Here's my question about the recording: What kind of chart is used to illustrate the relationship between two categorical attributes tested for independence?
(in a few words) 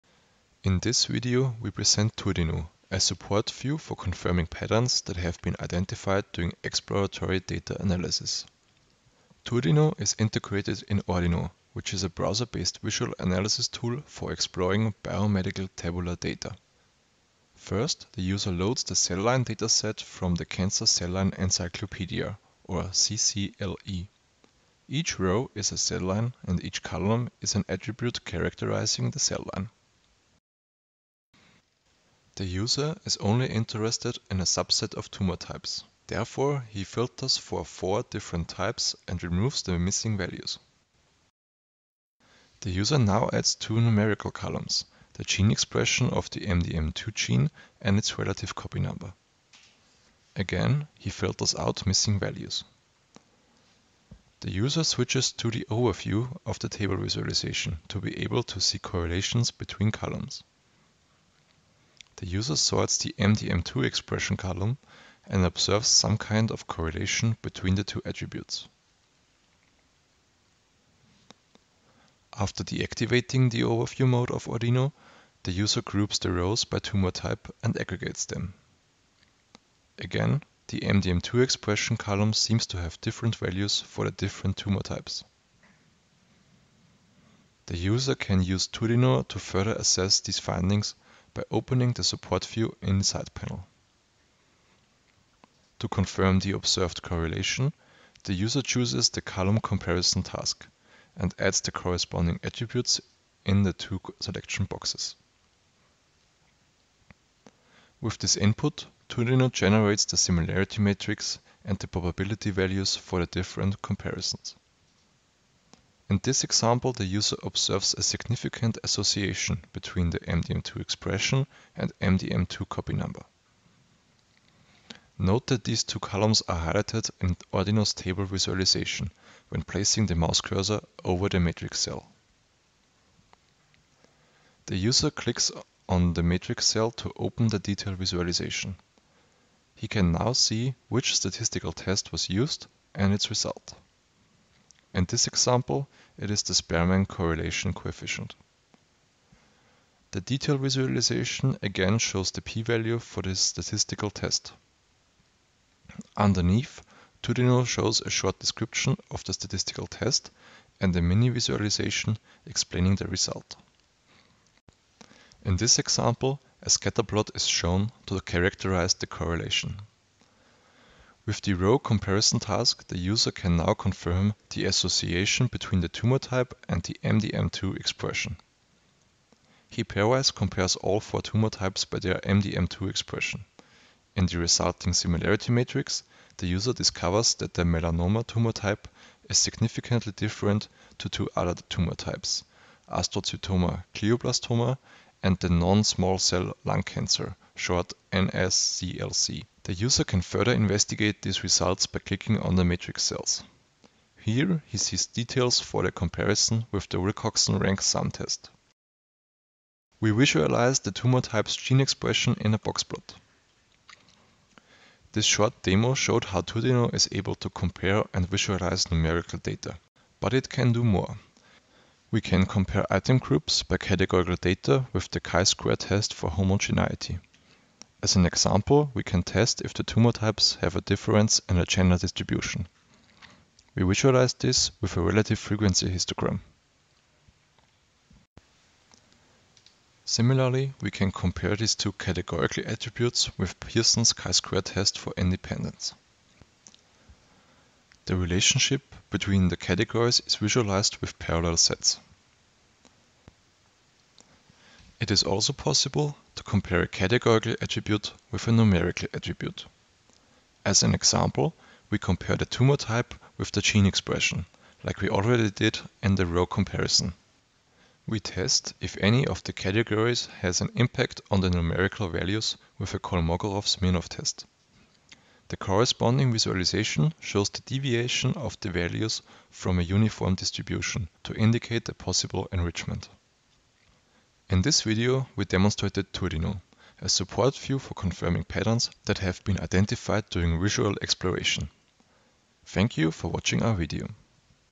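Parallel sets.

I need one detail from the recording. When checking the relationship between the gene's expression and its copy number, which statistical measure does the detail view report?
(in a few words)
Spearman correlation coefficient.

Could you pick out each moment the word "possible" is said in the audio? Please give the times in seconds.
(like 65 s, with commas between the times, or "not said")
255 s, 281 s.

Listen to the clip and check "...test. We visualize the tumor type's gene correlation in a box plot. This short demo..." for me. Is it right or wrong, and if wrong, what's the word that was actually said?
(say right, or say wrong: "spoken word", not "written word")
wrong: "expression", not "correlation".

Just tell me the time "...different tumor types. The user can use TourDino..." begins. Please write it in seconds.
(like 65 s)
84 s.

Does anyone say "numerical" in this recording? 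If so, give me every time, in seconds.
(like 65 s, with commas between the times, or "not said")
43 s, 218 s, 258 s, 271 s.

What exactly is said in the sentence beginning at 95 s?
To confirm the observed correlation, the user chooses the column comparison task and adds the corresponding attributes in the two selection boxes.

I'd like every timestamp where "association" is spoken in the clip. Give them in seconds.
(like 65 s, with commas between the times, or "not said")
118 s, 174 s.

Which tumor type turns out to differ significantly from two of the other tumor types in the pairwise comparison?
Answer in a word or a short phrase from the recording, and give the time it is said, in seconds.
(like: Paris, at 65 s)
Melanoma, at 187 s.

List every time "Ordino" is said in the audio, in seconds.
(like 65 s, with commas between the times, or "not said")
11 s, 74 s, 127 s.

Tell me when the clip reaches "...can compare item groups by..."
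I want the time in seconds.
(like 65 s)
222 s.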